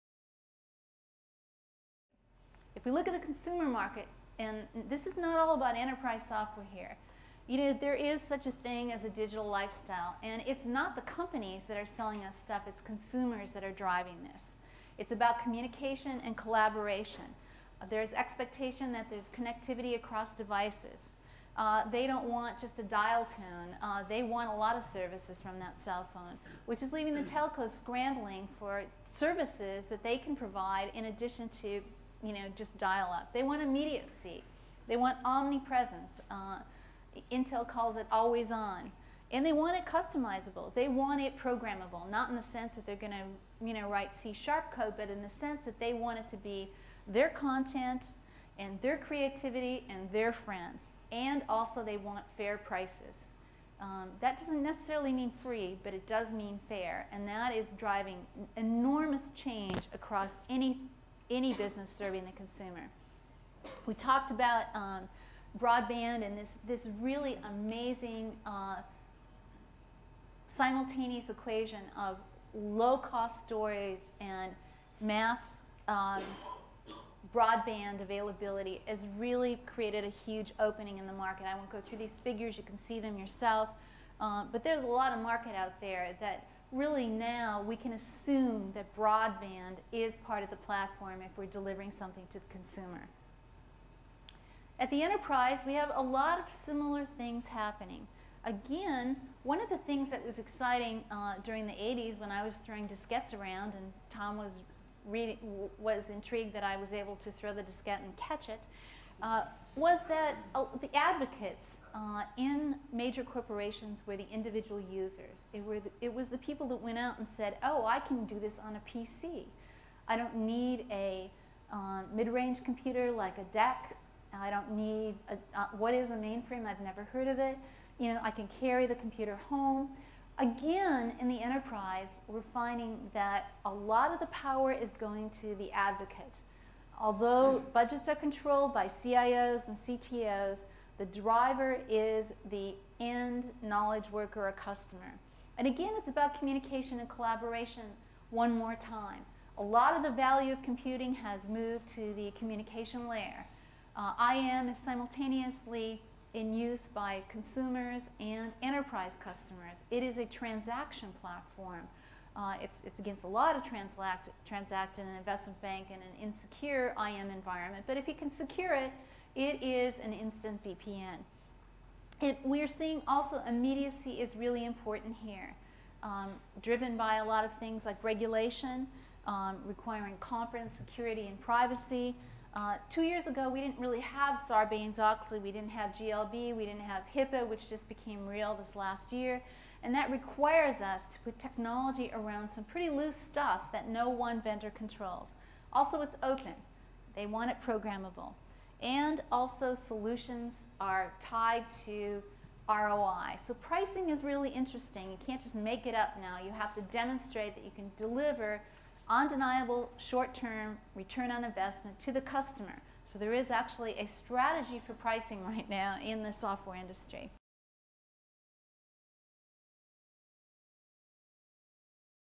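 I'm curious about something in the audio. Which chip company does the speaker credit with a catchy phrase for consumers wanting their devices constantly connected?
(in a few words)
Intel.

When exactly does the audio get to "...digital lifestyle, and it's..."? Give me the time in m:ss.
0:09.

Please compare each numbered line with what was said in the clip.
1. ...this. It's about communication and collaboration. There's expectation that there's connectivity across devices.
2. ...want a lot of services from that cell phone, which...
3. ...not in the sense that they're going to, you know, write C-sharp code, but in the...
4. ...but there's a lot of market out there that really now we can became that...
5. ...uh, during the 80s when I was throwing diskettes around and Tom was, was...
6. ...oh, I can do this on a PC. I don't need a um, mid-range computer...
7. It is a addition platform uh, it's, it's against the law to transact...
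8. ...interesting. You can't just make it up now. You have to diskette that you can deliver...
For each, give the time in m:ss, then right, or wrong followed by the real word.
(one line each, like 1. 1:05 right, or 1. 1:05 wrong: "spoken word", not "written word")
1. 0:14 right
2. 0:24 right
3. 0:42 right
4. 1:24 wrong: "assume", not "became"
5. 1:41 right
6. 1:57 right
7. 2:39 wrong: "transaction", not "addition"
8. 3:24 wrong: "demonstrate", not "diskette".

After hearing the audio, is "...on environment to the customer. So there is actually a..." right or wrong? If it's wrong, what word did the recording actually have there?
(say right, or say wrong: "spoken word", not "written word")
wrong: "investment", not "environment".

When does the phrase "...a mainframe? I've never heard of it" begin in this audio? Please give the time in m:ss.
2:06.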